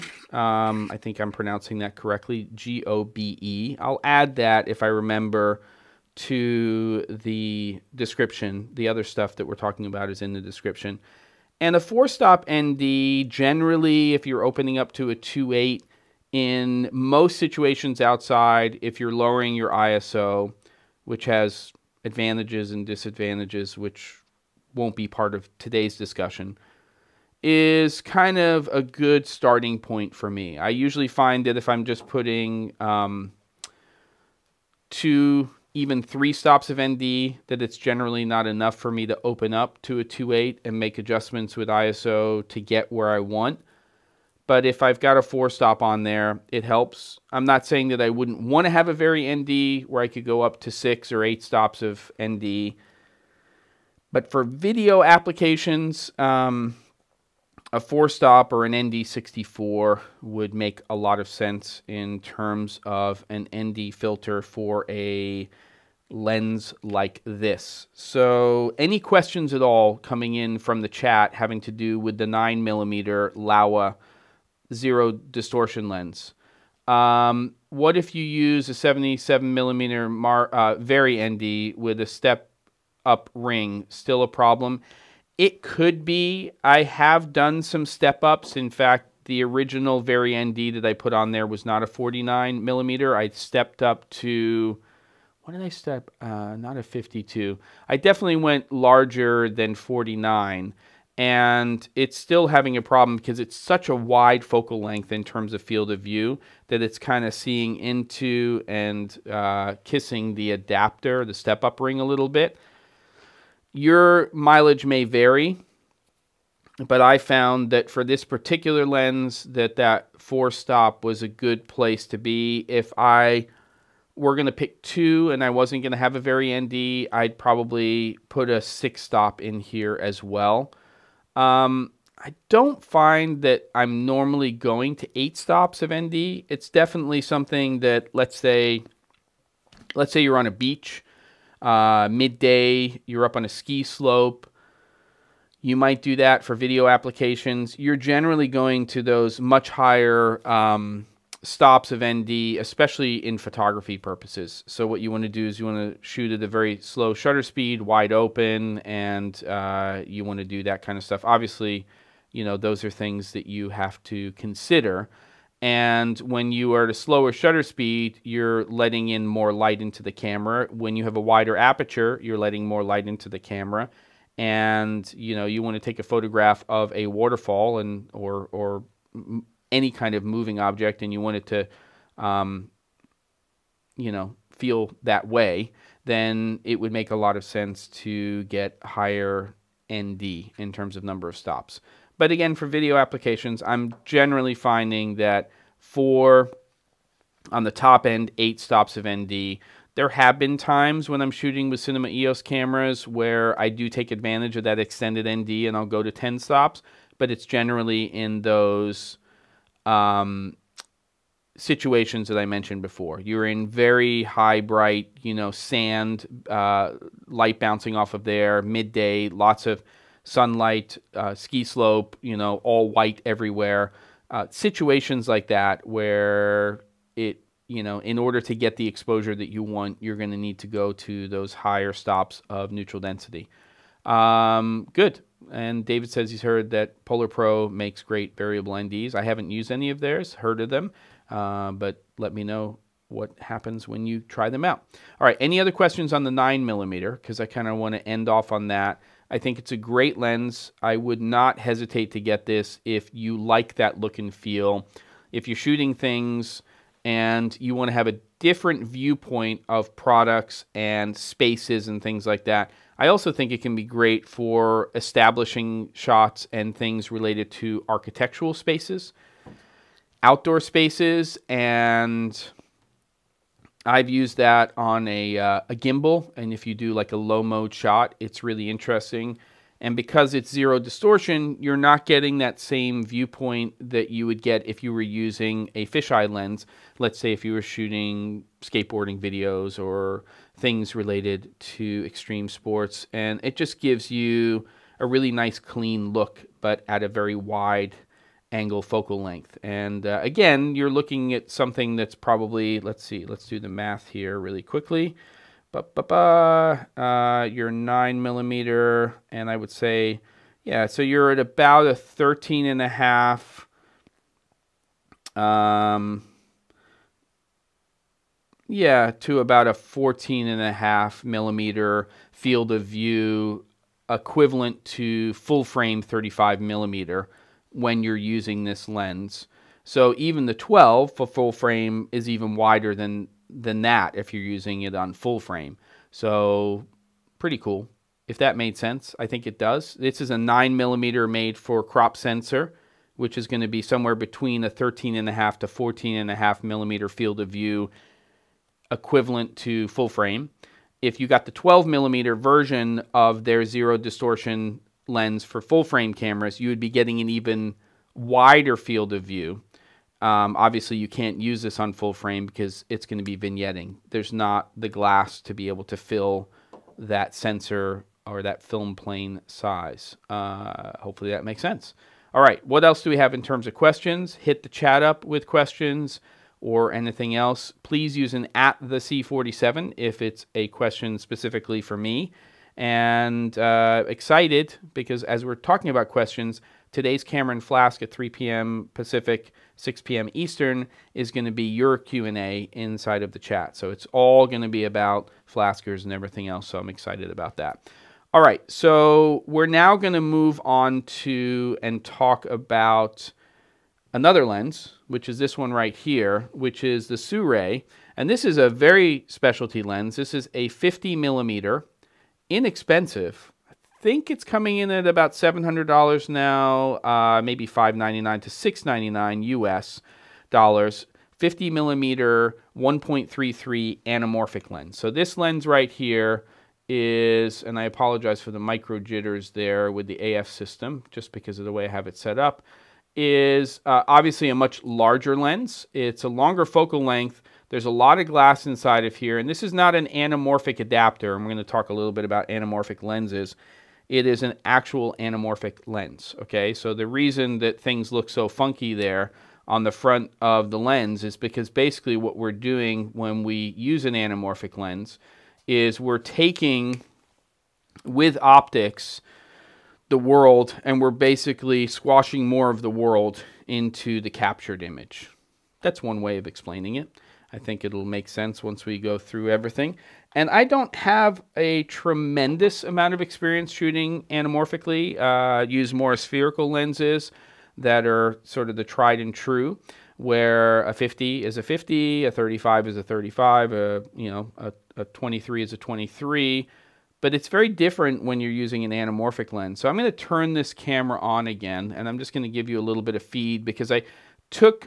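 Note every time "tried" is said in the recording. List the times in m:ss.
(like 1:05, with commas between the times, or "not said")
7:58.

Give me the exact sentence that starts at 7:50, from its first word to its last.
And I don't have a tremendous amount of experience shooting anamorphically.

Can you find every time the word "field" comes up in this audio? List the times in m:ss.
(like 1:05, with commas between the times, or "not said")
1:45, 5:22, 5:47, 5:58.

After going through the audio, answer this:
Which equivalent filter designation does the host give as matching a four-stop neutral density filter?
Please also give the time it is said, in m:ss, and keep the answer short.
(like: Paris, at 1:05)
ND64, at 0:58.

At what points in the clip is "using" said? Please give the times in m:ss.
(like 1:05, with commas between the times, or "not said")
4:45, 5:28, 5:34, 8:08.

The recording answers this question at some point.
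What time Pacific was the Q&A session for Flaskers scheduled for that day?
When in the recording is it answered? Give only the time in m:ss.
6:28.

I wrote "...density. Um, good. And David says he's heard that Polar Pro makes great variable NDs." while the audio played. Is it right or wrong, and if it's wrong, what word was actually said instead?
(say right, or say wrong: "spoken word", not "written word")
right.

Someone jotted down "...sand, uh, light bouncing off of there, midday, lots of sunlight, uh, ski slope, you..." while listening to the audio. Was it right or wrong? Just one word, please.
right.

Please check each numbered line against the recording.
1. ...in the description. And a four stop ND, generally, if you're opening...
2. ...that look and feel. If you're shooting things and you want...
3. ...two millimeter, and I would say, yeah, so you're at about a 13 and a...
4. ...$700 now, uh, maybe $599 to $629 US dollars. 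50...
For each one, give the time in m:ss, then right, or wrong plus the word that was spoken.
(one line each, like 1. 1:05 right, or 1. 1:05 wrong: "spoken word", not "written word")
1. 0:10 right
2. 4:13 right
3. 5:07 wrong: "nine", not "two"
4. 6:55 wrong: "699", not "629".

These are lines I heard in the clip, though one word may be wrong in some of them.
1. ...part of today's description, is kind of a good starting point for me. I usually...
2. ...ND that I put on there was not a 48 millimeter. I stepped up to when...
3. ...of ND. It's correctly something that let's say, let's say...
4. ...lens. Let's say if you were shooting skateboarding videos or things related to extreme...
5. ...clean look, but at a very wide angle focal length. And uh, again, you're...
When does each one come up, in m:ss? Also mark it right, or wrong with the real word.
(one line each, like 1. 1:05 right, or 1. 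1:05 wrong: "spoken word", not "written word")
1. 0:25 wrong: "discussion", not "description"
2. 1:30 wrong: "49", not "48"
3. 2:15 wrong: "definitely", not "correctly"
4. 4:46 right
5. 4:55 right.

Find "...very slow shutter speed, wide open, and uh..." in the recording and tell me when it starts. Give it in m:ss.
2:36.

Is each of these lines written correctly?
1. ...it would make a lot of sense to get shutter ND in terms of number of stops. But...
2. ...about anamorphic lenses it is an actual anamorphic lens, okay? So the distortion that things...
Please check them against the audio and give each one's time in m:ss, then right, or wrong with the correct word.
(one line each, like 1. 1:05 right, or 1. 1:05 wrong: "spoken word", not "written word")
1. 3:06 wrong: "higher", not "shutter"
2. 7:22 wrong: "reason", not "distortion".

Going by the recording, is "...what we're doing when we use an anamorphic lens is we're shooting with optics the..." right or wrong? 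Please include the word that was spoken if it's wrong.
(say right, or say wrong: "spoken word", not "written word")
wrong: "taking", not "shooting".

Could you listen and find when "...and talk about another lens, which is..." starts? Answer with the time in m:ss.
6:41.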